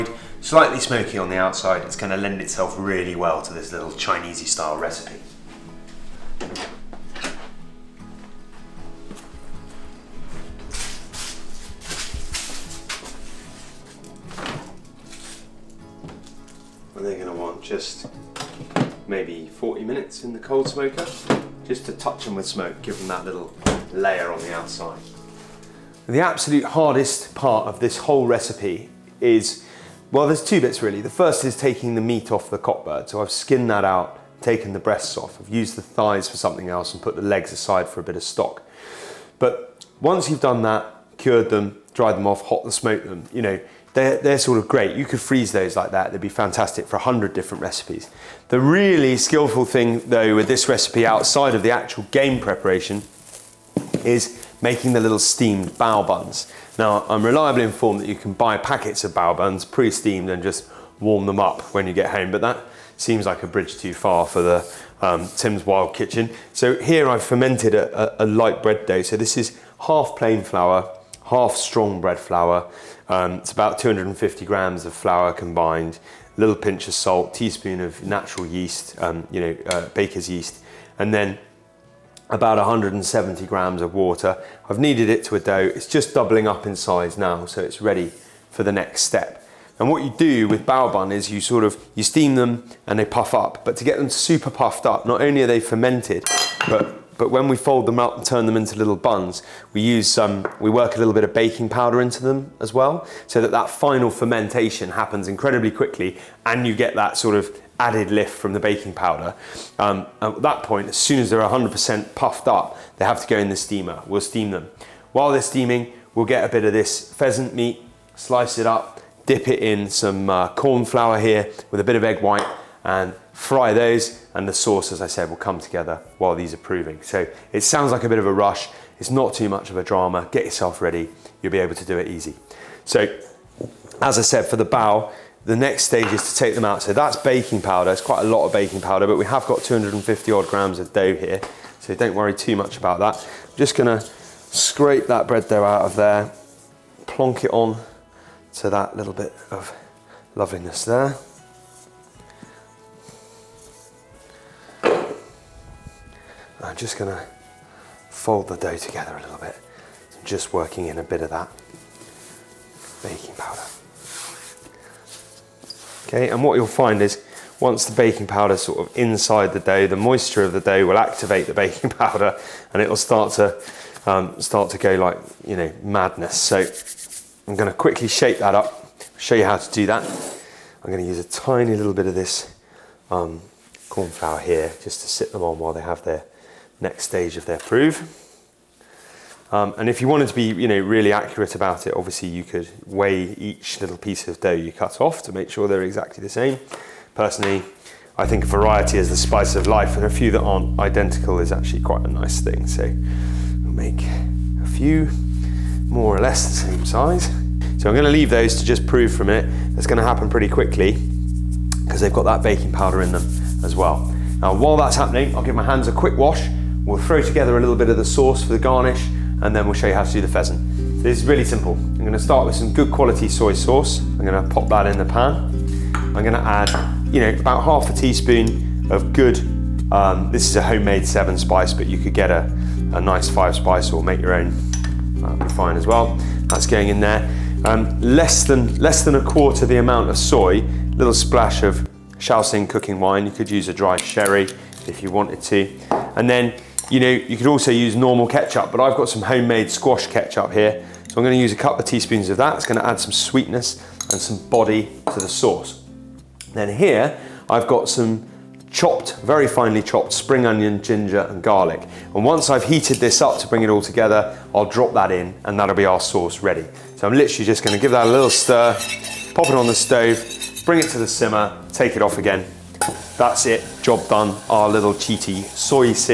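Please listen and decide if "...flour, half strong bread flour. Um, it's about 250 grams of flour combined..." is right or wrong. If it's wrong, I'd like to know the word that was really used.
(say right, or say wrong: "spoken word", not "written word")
right.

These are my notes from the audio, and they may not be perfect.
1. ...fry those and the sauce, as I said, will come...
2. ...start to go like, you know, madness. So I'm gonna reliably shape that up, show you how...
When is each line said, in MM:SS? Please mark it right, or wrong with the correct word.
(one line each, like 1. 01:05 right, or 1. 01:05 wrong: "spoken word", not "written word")
1. 02:03 right
2. 02:54 wrong: "quickly", not "reliably".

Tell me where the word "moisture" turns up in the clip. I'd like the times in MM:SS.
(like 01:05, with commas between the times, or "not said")
02:49.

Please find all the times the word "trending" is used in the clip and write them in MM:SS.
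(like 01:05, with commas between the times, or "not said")
not said.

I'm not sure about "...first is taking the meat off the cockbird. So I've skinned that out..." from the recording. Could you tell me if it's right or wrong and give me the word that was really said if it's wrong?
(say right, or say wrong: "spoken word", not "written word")
right.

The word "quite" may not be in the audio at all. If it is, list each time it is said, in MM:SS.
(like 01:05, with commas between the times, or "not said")
02:18, 03:21.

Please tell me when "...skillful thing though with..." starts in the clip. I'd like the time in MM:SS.
00:49.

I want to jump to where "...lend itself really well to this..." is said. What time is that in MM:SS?
00:02.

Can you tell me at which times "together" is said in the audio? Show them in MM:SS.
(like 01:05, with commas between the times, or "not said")
02:05, 02:38, 03:37, 04:23.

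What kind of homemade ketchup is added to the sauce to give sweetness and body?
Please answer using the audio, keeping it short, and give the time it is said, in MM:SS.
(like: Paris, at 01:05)
squash ketchup, at 04:09.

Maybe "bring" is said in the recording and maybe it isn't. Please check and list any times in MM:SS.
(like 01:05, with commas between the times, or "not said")
04:23, 04:30.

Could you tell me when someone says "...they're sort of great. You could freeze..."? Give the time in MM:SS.
00:44.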